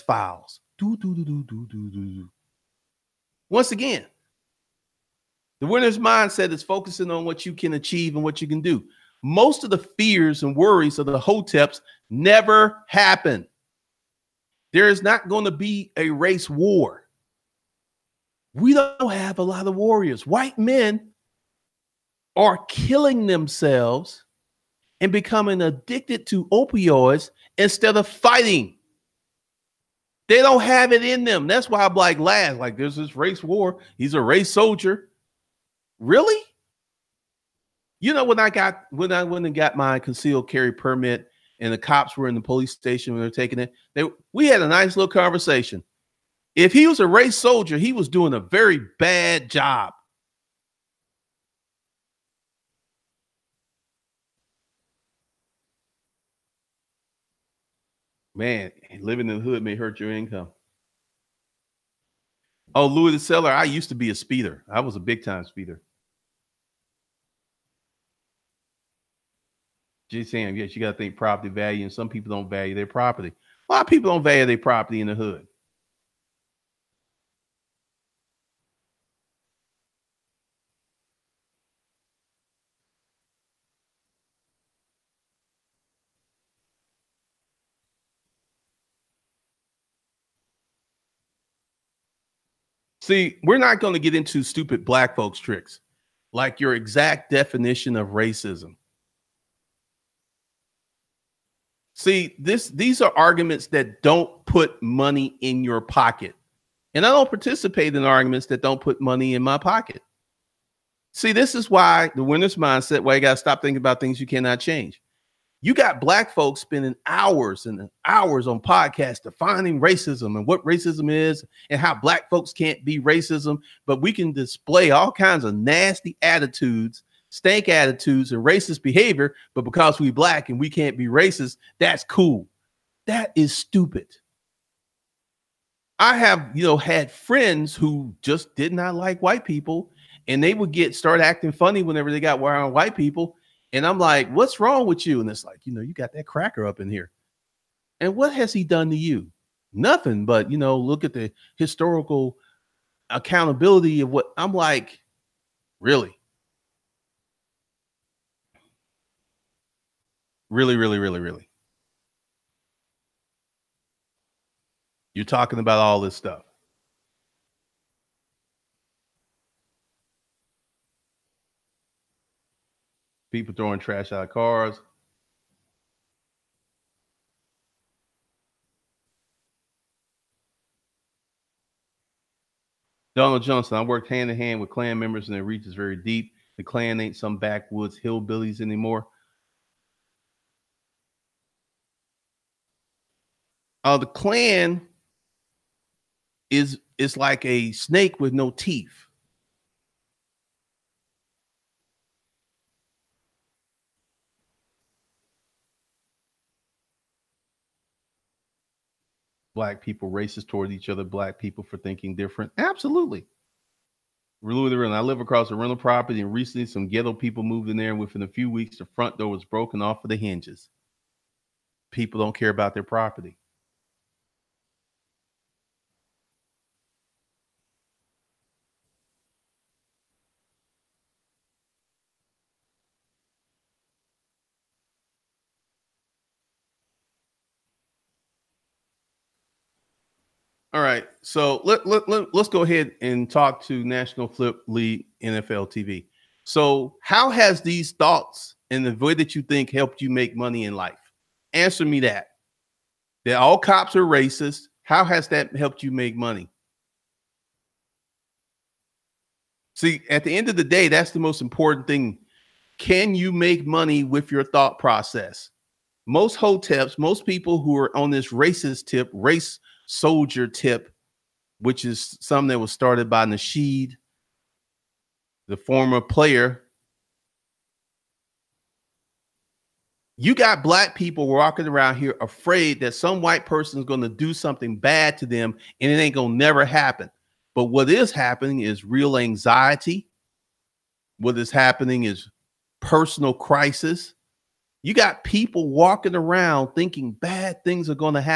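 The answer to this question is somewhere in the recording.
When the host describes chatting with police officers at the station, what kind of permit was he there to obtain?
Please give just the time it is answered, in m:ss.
0:39.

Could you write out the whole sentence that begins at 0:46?
If he was a race soldier, he was doing a very bad job.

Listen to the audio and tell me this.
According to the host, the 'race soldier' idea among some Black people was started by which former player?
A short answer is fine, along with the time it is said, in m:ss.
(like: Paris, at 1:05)
Nasheed, at 4:33.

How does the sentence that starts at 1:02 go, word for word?
Oh, Louis the Seller, I used to be a speeder.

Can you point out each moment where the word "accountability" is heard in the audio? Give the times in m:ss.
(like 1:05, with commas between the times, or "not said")
2:33.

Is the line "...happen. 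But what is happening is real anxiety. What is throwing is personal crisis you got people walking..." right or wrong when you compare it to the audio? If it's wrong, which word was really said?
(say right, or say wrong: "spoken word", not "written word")
wrong: "happening", not "throwing".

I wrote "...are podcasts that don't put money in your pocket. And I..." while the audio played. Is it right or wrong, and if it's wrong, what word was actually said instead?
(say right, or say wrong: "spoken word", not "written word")
wrong: "arguments", not "podcasts".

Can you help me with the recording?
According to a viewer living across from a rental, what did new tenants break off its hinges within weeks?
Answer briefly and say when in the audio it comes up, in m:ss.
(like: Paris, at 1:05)
The front door, at 3:38.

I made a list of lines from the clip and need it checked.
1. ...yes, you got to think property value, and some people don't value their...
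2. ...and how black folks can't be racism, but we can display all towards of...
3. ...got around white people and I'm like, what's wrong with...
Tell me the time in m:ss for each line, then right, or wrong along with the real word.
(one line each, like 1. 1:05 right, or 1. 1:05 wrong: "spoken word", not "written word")
1. 1:10 right
2. 2:01 wrong: "kinds", not "towards"
3. 2:22 right.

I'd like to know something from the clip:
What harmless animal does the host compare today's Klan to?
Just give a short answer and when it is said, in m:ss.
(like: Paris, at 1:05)
A snake with no teeth, at 3:17.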